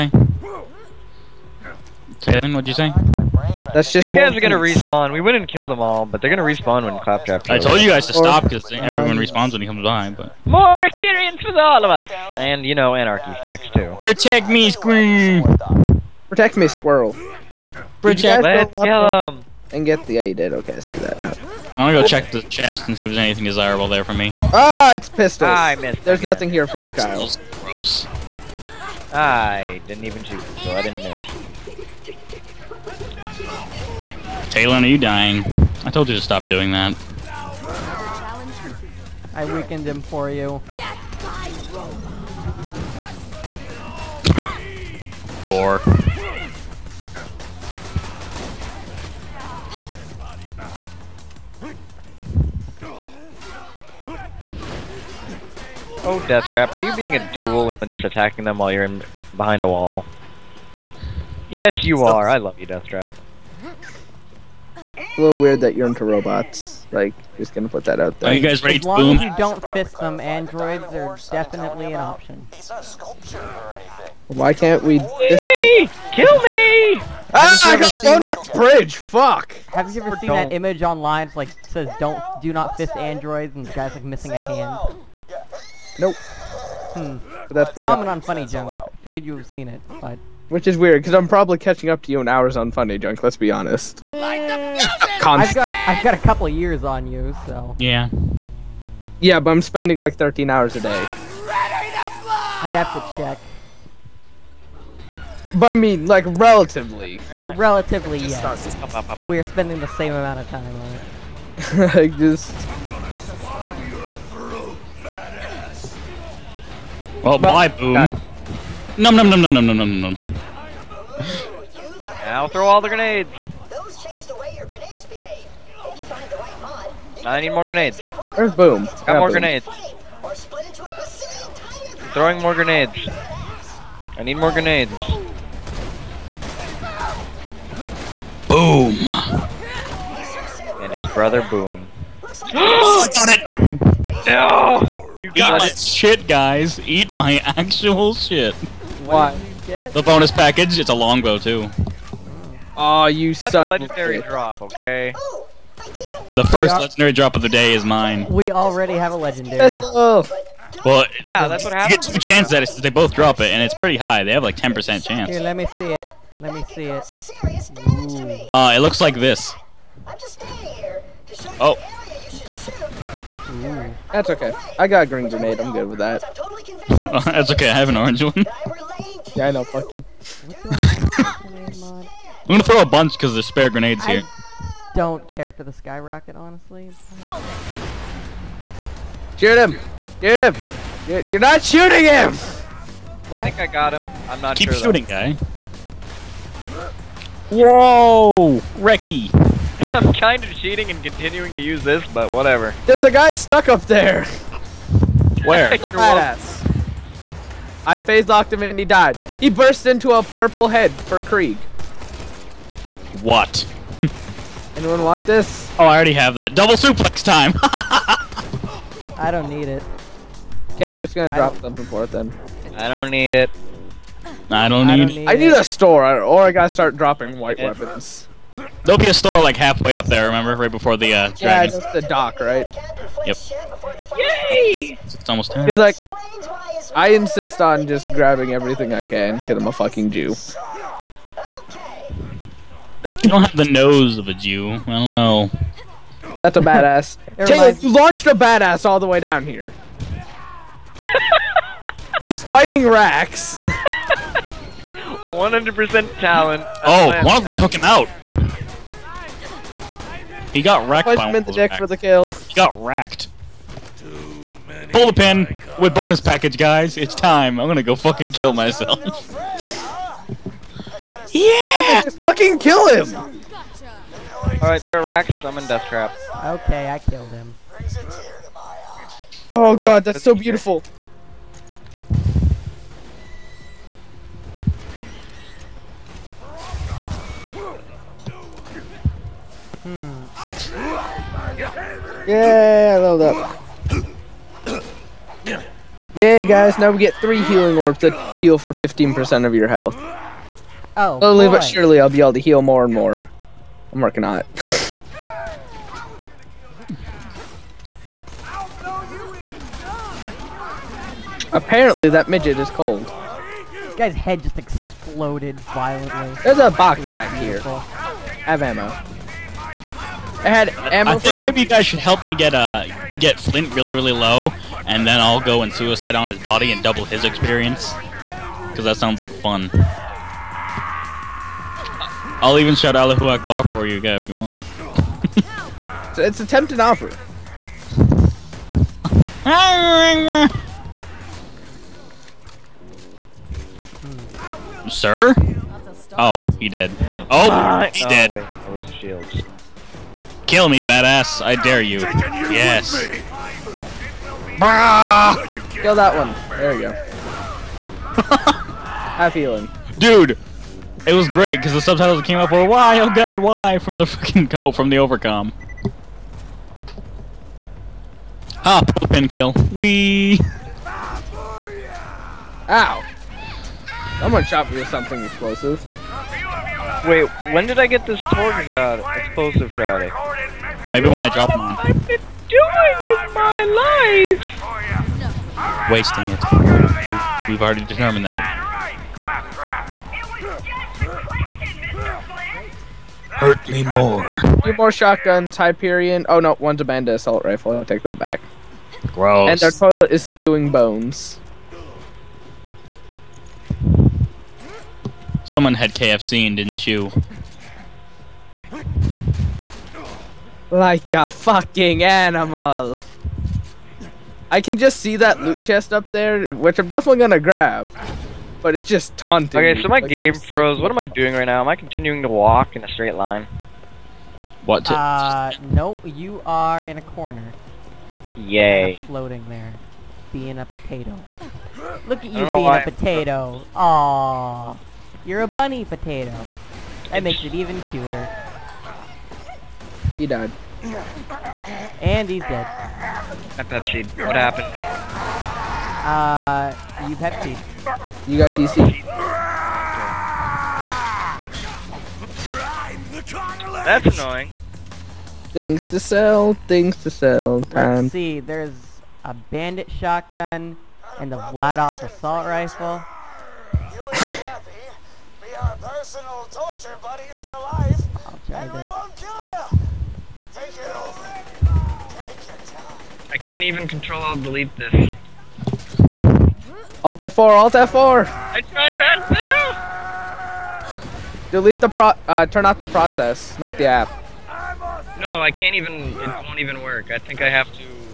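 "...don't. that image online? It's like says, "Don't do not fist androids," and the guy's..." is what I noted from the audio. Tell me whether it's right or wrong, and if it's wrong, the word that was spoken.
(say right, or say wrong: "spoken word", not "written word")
right.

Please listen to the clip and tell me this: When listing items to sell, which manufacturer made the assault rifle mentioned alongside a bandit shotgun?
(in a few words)
Vladof.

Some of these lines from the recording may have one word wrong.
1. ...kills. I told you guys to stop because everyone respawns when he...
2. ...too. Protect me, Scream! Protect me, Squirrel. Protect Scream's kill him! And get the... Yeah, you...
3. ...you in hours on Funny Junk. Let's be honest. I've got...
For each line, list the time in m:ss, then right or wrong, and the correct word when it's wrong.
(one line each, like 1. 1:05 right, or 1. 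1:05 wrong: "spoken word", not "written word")
1. 0:07 right
2. 0:13 wrong: "Let", not "Scream"
3. 1:32 right.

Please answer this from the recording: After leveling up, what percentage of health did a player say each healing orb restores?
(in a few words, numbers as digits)
15%.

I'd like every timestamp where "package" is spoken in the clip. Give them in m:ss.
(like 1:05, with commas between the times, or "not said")
2:30, 4:26.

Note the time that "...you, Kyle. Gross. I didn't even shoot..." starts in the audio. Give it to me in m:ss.
0:26.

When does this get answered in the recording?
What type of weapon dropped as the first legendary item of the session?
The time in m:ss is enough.
2:30.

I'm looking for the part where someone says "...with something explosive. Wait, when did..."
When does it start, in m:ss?
6:14.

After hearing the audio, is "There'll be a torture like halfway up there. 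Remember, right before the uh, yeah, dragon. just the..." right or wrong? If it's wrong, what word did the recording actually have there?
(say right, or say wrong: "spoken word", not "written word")
wrong: "store", not "torture".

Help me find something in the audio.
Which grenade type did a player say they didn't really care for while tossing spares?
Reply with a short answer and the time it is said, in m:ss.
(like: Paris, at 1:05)
skyrocket, at 3:05.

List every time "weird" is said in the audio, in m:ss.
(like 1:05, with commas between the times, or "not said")
1:05, 1:30.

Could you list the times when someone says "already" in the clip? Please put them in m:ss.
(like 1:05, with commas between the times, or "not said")
2:38, 3:35, 6:27.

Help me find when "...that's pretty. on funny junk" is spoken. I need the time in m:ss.
1:27.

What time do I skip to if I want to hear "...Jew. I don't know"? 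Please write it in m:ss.
4:04.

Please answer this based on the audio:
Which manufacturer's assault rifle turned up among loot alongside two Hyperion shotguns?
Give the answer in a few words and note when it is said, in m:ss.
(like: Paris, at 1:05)
Demanda, at 6:36.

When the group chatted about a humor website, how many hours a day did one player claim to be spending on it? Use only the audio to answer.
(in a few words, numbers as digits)
13.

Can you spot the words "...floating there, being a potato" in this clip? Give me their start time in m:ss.
7:09.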